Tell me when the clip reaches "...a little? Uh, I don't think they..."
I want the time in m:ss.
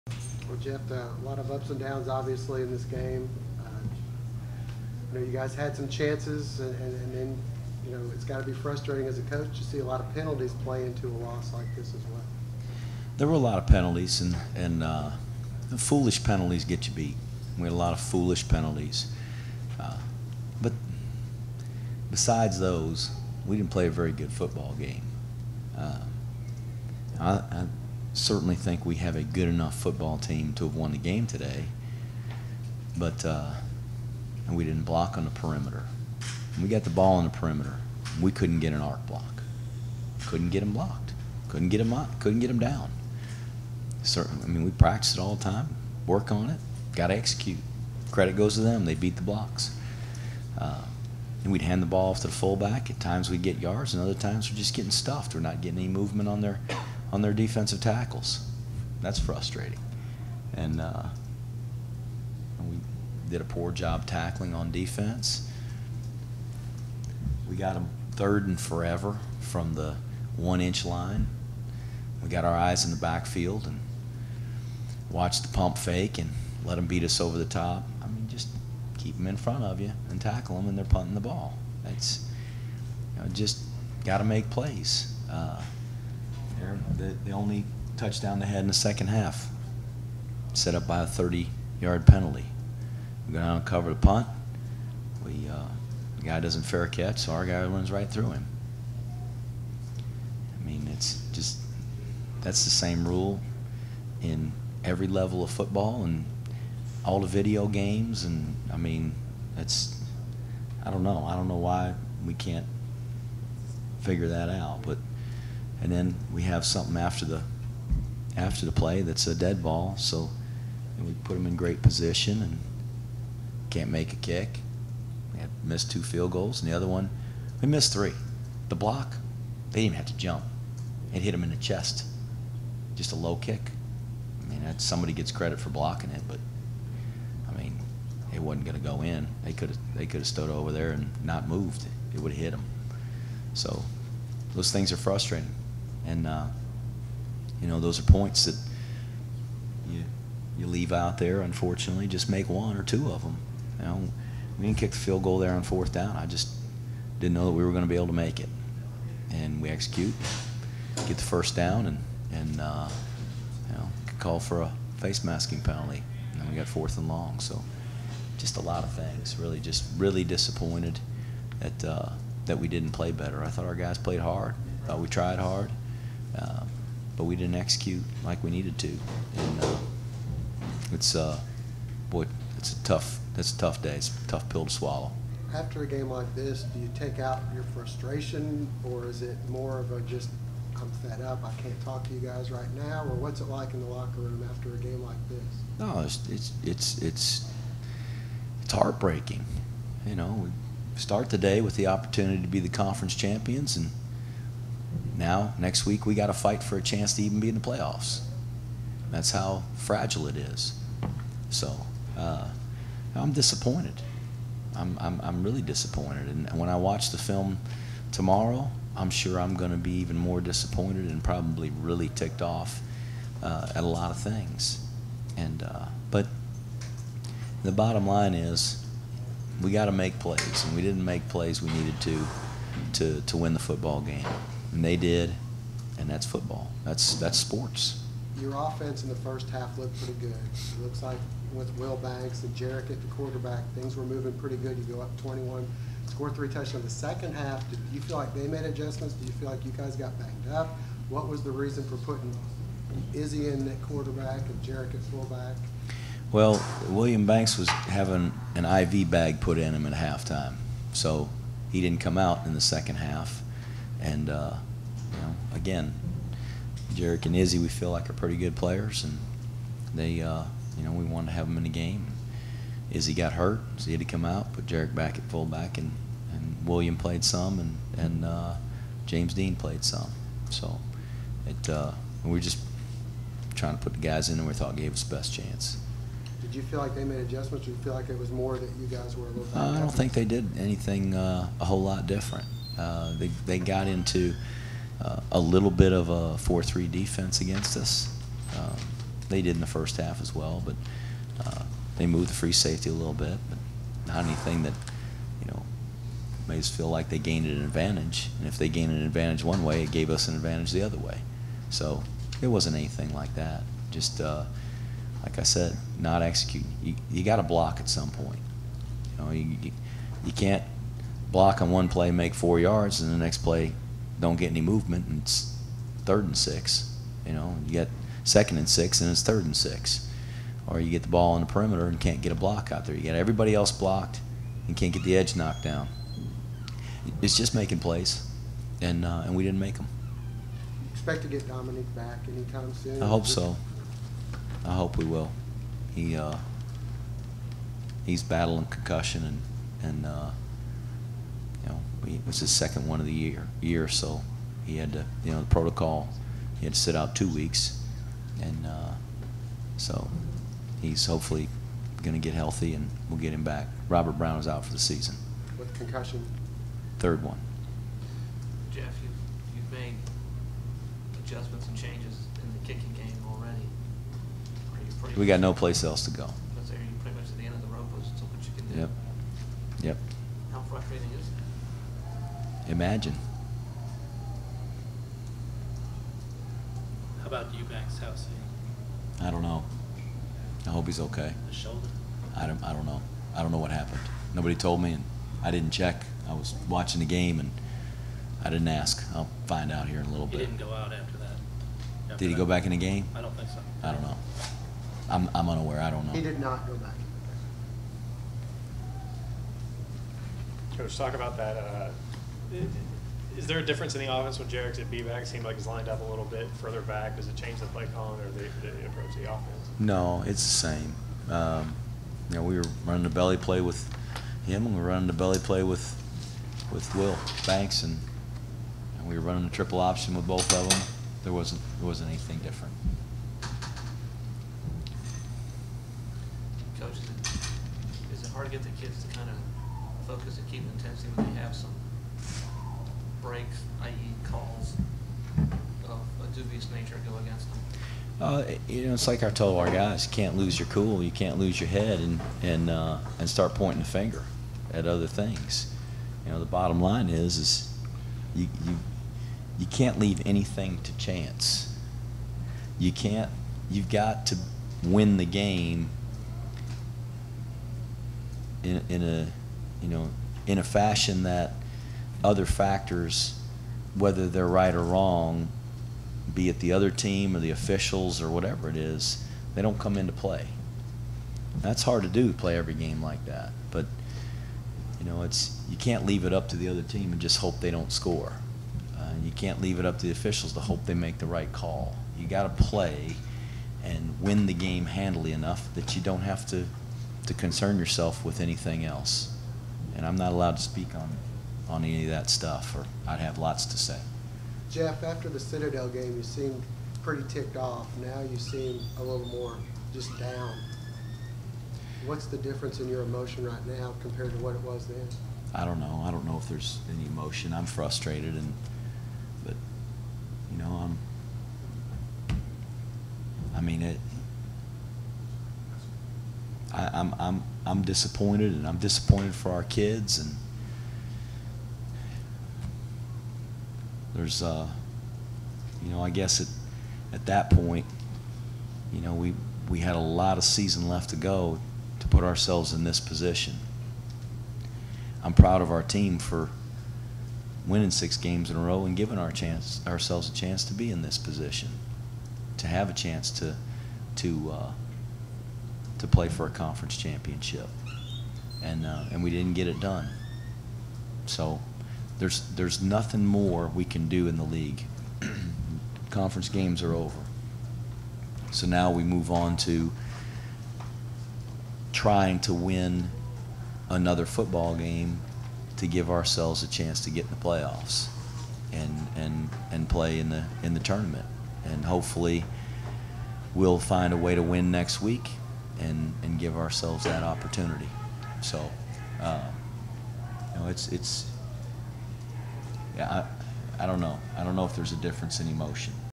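4:49.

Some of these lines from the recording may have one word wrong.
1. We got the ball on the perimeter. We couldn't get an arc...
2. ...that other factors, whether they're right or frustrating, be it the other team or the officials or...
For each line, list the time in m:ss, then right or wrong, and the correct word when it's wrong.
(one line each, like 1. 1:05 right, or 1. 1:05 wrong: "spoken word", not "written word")
1. 0:36 right
2. 7:51 wrong: "wrong", not "frustrating".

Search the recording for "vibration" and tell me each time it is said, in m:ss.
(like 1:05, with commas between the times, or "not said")
not said.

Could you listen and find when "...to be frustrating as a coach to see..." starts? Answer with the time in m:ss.
0:08.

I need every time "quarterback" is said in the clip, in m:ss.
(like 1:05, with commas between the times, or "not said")
4:03, 4:13.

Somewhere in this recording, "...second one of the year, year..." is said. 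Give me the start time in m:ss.
5:52.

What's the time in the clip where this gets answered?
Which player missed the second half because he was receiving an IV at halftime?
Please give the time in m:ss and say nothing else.
4:16.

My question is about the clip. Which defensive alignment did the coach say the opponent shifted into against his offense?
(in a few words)
4-3.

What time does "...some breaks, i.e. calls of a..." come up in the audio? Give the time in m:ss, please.
7:21.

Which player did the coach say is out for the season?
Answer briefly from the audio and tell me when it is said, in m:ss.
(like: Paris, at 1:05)
Robert Brown, at 6:03.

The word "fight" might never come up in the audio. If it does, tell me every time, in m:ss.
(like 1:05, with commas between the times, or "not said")
3:26.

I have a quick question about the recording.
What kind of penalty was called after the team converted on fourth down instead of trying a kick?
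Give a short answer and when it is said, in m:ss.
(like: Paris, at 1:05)
Face masking, at 2:44.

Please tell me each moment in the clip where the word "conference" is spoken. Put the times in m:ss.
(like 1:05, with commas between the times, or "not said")
3:22, 9:16, 9:26.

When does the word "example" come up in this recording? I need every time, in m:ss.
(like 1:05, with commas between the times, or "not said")
not said.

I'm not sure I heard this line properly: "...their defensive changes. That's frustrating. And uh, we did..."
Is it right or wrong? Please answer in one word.
wrong.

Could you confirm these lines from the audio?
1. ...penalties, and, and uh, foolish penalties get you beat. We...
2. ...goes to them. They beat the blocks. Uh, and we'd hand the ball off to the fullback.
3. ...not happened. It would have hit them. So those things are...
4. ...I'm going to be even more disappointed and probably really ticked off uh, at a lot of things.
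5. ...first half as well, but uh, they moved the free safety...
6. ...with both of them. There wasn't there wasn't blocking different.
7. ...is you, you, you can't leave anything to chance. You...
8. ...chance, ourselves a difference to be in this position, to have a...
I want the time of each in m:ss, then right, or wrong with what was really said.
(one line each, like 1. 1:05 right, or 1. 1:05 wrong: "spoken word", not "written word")
1. 0:13 right
2. 0:48 right
3. 2:21 wrong: "moved", not "happened"
4. 3:39 right
5. 4:59 right
6. 7:10 wrong: "anything", not "blocking"
7. 7:37 right
8. 9:09 wrong: "chance", not "difference".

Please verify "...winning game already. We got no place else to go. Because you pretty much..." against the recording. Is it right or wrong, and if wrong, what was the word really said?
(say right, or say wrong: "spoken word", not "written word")
wrong: "kicking", not "winning".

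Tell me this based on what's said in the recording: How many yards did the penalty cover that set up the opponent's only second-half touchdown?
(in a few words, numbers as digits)
30.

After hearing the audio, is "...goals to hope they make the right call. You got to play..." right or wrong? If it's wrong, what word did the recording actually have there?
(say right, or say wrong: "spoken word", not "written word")
wrong: "officials", not "goals".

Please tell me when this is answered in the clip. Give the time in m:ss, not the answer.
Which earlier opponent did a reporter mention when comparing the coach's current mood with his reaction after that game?
8:25.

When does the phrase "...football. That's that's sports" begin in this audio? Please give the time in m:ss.
3:56.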